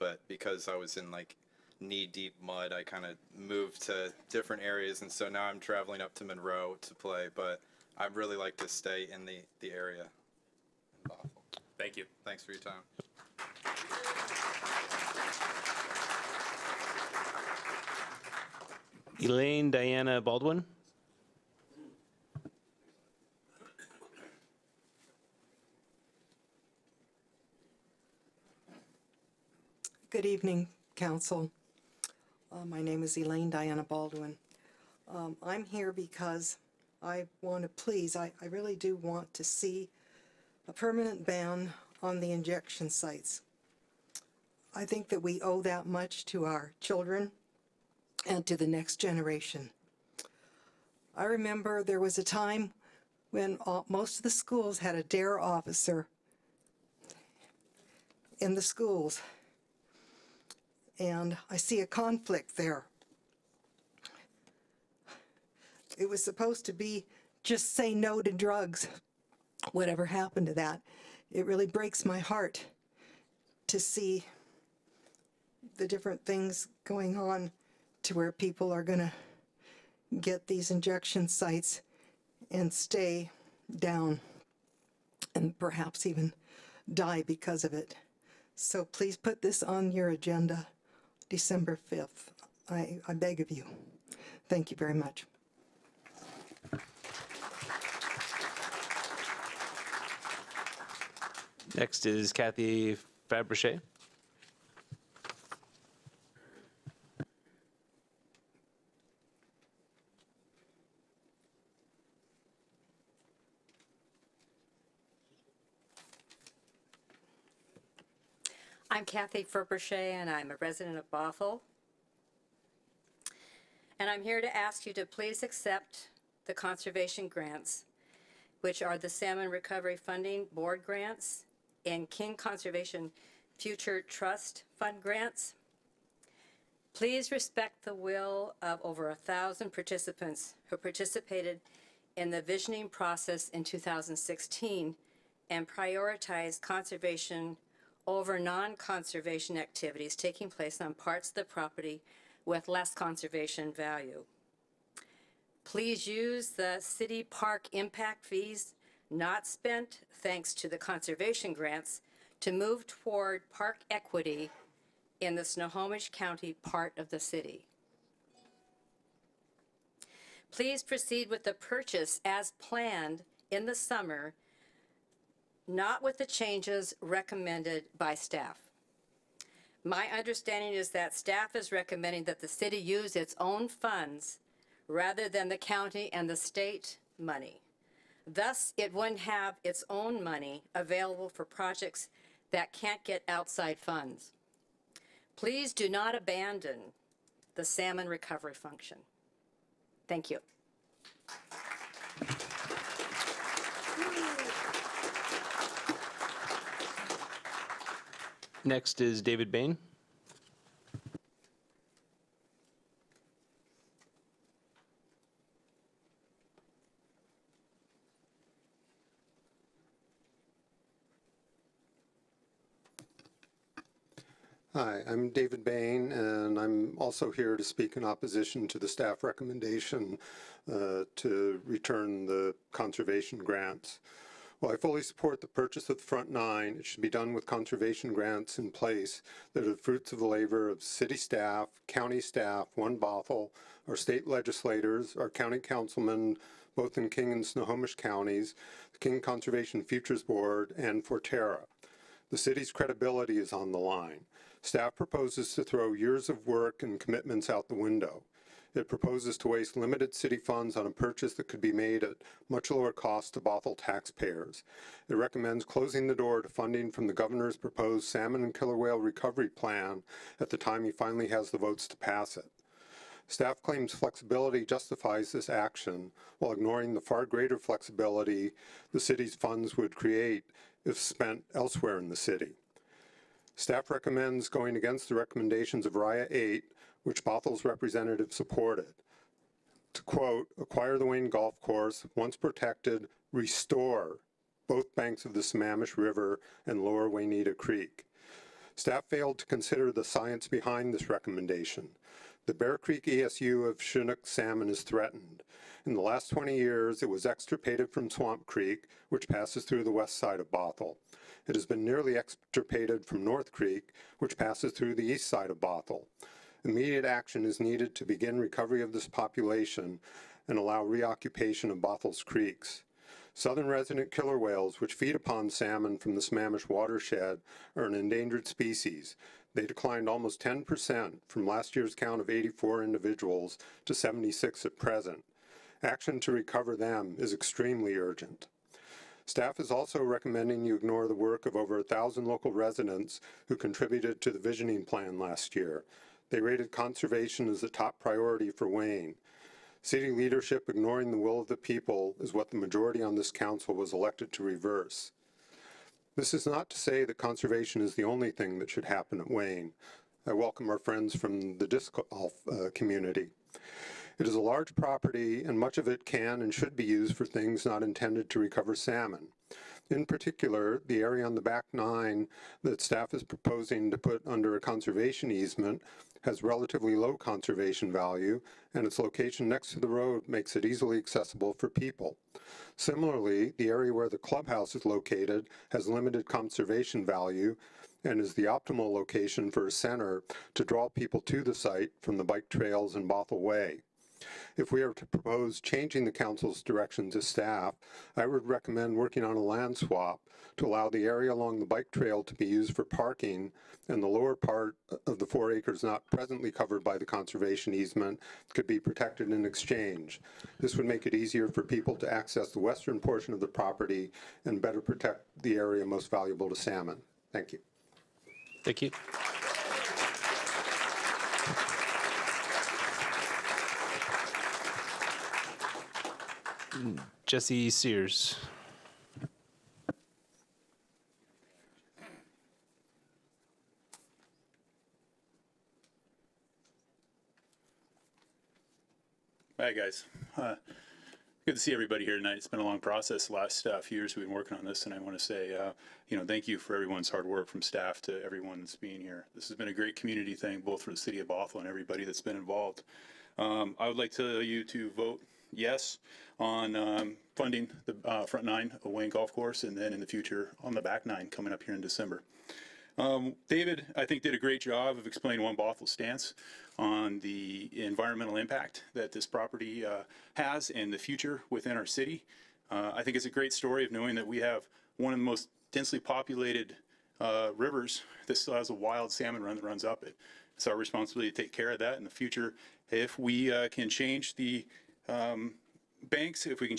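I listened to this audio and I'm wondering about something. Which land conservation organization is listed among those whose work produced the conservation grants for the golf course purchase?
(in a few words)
Forterra.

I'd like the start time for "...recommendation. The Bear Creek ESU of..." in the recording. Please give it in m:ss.
5:01.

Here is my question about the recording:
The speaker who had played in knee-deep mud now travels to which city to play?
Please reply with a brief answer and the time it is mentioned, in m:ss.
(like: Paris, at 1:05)
Monroe, at 0:06.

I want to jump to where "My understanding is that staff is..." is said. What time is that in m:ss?
2:59.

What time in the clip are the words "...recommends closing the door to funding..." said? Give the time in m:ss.
4:25.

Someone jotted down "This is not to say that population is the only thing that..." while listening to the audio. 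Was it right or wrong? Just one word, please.
wrong.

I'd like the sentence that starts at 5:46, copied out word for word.
They rated conservation as the top priority for Wayne.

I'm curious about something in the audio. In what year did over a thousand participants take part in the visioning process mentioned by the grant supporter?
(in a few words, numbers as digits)
2016.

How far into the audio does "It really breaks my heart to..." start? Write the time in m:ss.
1:11.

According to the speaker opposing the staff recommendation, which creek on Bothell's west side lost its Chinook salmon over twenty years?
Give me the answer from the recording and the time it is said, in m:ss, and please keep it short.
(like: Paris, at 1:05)
Swamp Creek, at 5:08.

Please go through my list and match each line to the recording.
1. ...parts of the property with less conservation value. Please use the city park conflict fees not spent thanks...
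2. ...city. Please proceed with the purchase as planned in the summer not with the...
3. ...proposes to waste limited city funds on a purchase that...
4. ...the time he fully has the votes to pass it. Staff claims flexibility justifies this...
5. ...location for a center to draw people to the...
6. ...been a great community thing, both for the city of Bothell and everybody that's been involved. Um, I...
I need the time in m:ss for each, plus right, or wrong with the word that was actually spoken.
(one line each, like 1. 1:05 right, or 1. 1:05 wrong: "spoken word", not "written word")
1. 2:30 wrong: "impact", not "conflict"
2. 2:47 right
3. 4:18 right
4. 4:30 wrong: "finally", not "fully"
5. 6:28 right
6. 7:29 right.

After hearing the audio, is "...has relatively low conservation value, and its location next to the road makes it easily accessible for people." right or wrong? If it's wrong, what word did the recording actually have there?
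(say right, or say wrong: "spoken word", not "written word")
right.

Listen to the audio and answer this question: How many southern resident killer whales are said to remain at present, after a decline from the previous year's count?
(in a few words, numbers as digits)
76.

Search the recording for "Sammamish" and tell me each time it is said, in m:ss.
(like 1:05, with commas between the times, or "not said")
4:55, 5:26.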